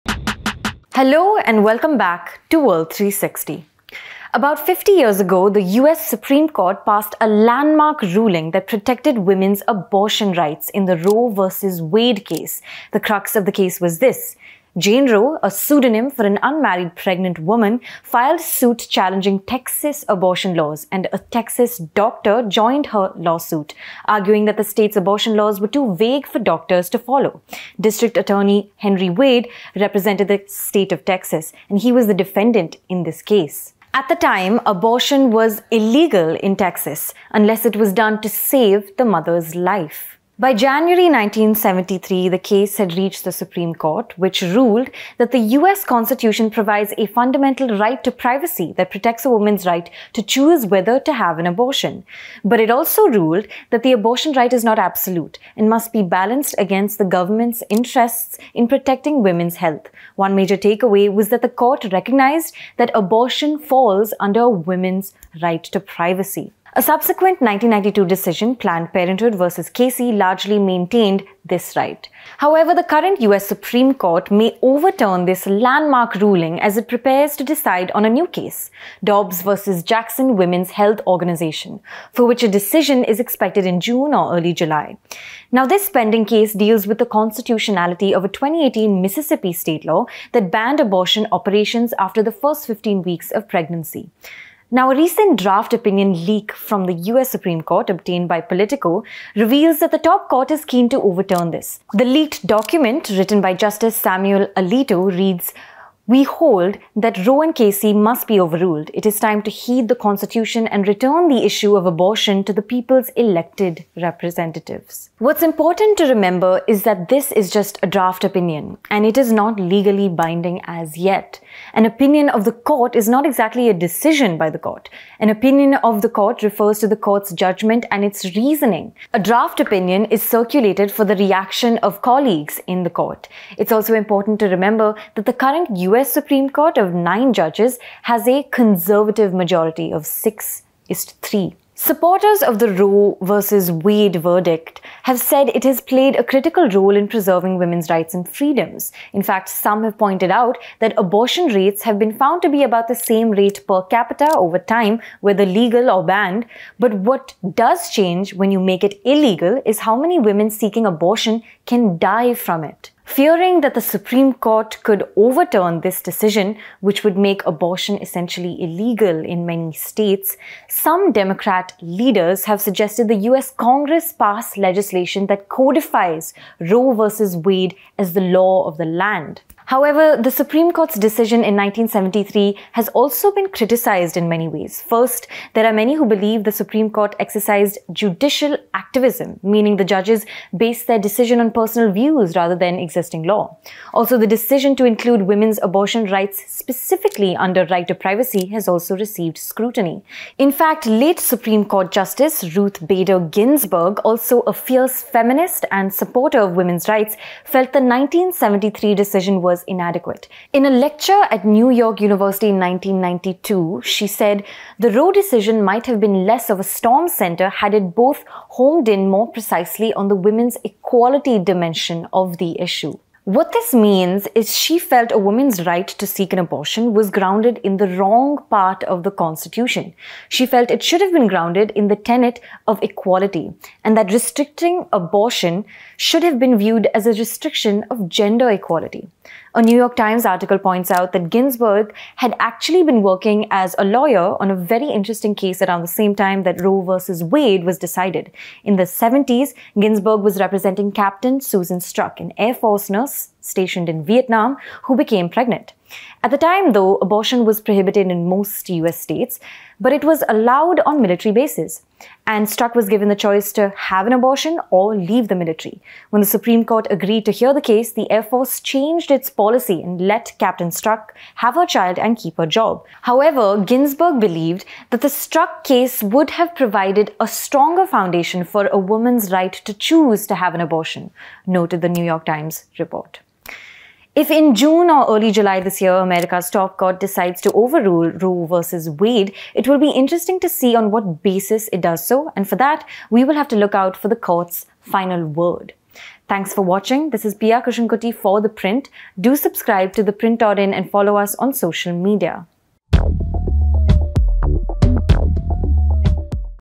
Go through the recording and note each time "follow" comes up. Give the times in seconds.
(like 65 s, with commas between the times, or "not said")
26 s, 300 s.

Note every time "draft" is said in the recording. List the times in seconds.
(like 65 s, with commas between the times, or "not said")
95 s, 117 s, 129 s.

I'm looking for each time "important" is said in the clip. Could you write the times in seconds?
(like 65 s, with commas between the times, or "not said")
115 s, 133 s.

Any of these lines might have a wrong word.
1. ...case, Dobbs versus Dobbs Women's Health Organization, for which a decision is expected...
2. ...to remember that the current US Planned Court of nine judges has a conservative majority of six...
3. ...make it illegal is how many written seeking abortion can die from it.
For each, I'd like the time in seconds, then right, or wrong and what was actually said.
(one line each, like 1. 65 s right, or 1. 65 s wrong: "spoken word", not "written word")
1. 78 s wrong: "Jackson", not "Dobbs"
2. 134 s wrong: "Supreme", not "Planned"
3. 158 s wrong: "women", not "written".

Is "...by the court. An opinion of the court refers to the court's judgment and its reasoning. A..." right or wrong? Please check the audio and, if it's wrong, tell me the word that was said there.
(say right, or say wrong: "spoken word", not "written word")
right.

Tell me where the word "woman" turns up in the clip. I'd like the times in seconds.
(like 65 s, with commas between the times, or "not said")
17 s, 49 s, 225 s, 278 s.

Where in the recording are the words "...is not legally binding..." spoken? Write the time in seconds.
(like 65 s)
119 s.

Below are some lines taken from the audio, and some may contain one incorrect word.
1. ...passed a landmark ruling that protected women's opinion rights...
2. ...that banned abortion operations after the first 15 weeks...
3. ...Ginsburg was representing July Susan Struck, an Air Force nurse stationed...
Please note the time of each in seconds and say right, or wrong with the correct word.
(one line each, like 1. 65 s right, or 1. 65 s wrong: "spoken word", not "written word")
1. 6 s wrong: "abortion", not "opinion"
2. 90 s right
3. 249 s wrong: "Captain", not "July".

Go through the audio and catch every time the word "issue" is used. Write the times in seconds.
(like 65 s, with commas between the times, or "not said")
111 s, 222 s.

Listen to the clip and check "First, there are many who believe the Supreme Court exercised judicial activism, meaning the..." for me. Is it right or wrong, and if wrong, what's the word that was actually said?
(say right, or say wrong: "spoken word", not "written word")
right.